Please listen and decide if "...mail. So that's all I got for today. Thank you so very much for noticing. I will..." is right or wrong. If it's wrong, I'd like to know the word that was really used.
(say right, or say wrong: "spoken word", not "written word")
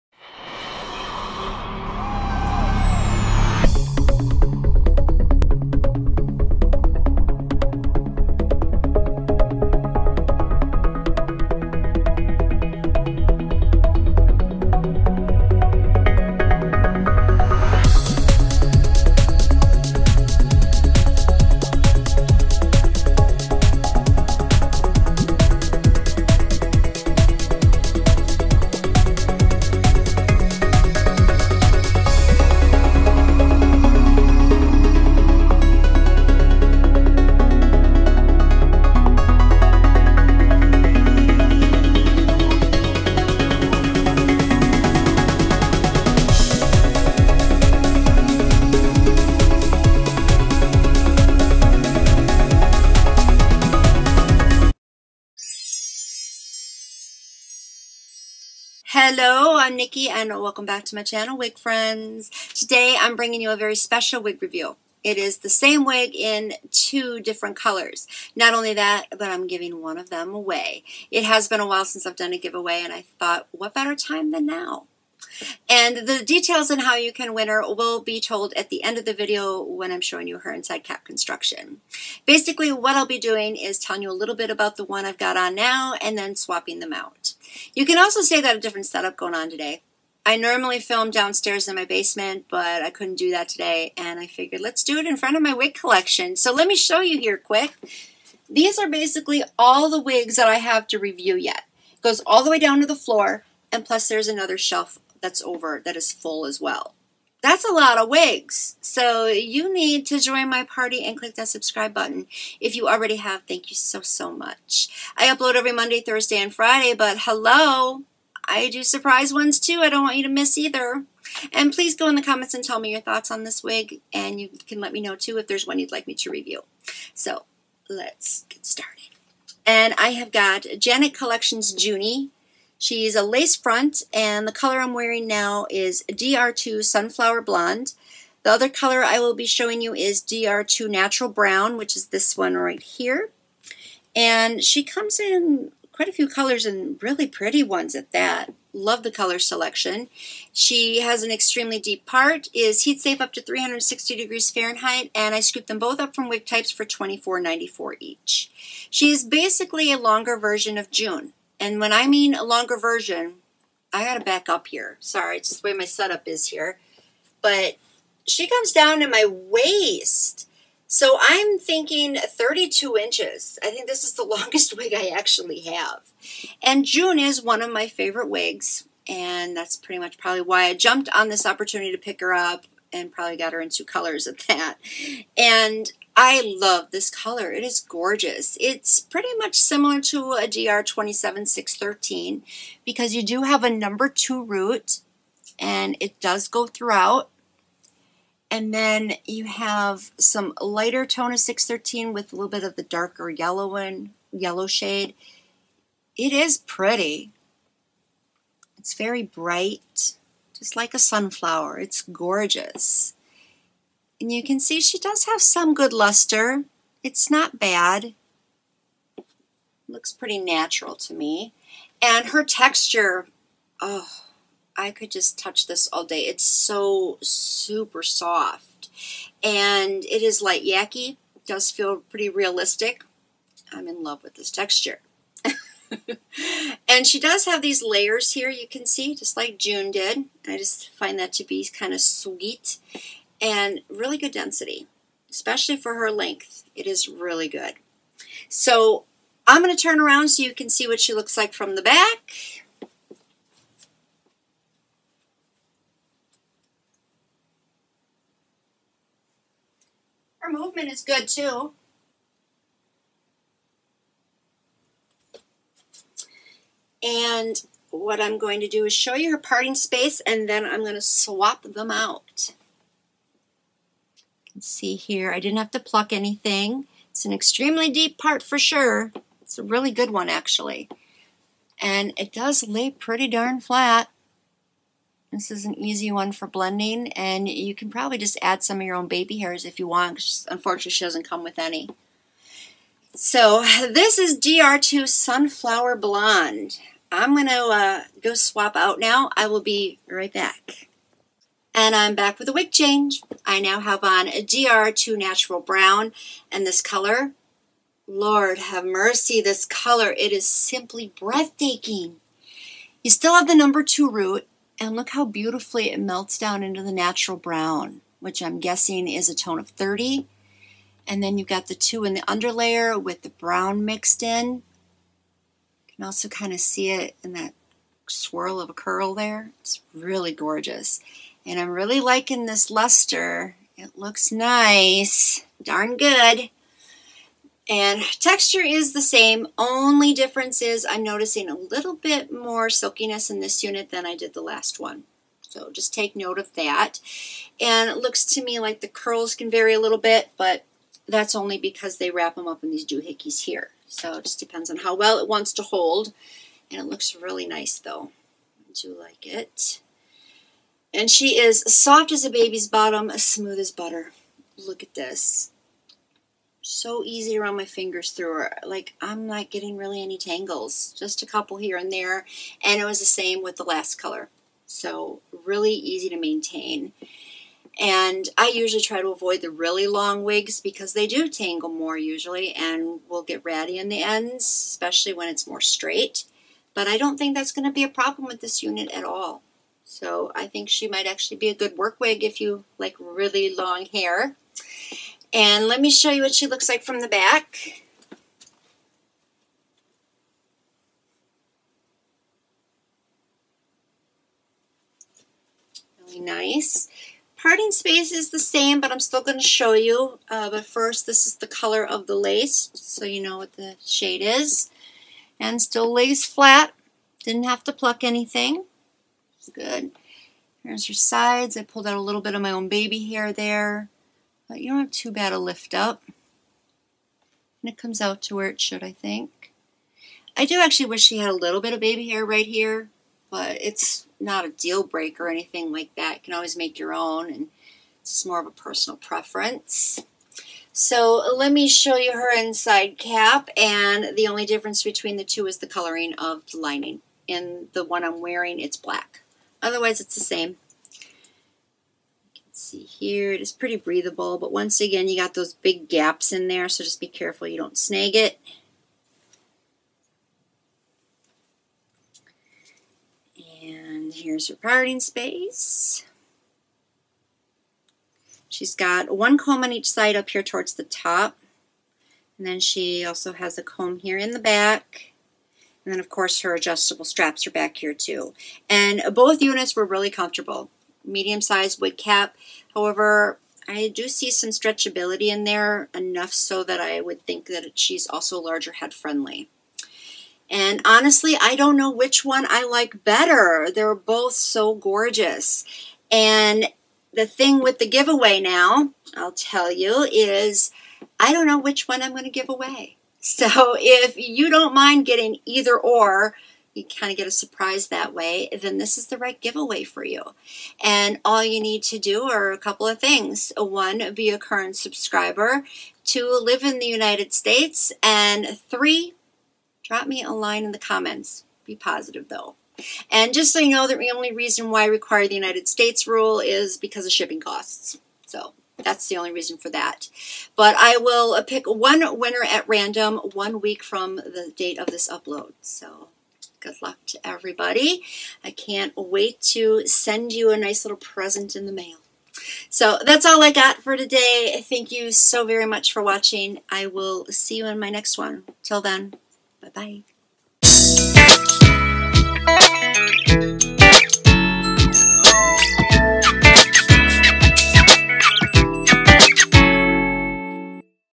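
wrong: "watching", not "noticing".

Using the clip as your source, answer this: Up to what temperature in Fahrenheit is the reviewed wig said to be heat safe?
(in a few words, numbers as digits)
360 degrees.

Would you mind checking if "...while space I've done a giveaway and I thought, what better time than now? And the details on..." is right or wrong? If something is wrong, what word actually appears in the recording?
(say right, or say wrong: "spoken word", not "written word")
wrong: "since", not "space".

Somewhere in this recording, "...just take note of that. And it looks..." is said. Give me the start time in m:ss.
5:45.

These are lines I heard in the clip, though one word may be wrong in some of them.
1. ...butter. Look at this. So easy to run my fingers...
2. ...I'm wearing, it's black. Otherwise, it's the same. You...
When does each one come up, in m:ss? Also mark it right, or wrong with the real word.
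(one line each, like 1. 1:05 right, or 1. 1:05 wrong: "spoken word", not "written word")
1. 6:03 right
2. 7:28 right.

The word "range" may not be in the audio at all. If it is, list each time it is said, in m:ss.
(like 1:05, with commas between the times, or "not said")
not said.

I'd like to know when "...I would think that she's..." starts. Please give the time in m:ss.
8:06.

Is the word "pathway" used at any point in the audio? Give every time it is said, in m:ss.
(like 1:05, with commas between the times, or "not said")
not said.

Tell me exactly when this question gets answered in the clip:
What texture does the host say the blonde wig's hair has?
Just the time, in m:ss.
3:50.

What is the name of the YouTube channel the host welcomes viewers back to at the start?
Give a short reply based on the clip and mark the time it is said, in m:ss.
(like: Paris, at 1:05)
Wig Friends, at 1:01.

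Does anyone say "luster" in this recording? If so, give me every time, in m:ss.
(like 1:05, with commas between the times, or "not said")
3:35, 5:32.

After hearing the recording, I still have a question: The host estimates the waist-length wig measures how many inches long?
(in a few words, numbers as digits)
32 inches.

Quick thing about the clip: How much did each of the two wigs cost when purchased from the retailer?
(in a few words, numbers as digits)
$24.94.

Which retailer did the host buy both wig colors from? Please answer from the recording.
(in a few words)
Wig Types.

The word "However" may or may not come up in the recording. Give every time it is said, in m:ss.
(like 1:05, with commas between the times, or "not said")
8:02.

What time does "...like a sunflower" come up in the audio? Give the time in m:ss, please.
3:30.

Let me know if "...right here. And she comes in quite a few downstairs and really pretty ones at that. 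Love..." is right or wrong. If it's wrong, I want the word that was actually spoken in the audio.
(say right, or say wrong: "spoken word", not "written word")
wrong: "colors", not "downstairs".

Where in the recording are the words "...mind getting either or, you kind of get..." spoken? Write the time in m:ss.
8:24.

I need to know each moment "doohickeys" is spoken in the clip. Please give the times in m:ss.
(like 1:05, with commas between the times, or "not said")
5:52.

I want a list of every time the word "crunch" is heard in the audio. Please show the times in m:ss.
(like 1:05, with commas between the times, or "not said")
not said.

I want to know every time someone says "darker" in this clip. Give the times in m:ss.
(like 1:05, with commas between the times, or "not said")
3:22.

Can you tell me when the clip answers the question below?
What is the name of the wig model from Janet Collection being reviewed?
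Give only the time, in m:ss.
2:11.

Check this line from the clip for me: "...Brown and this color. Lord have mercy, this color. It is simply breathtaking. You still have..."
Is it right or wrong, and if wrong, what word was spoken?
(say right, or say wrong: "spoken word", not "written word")
right.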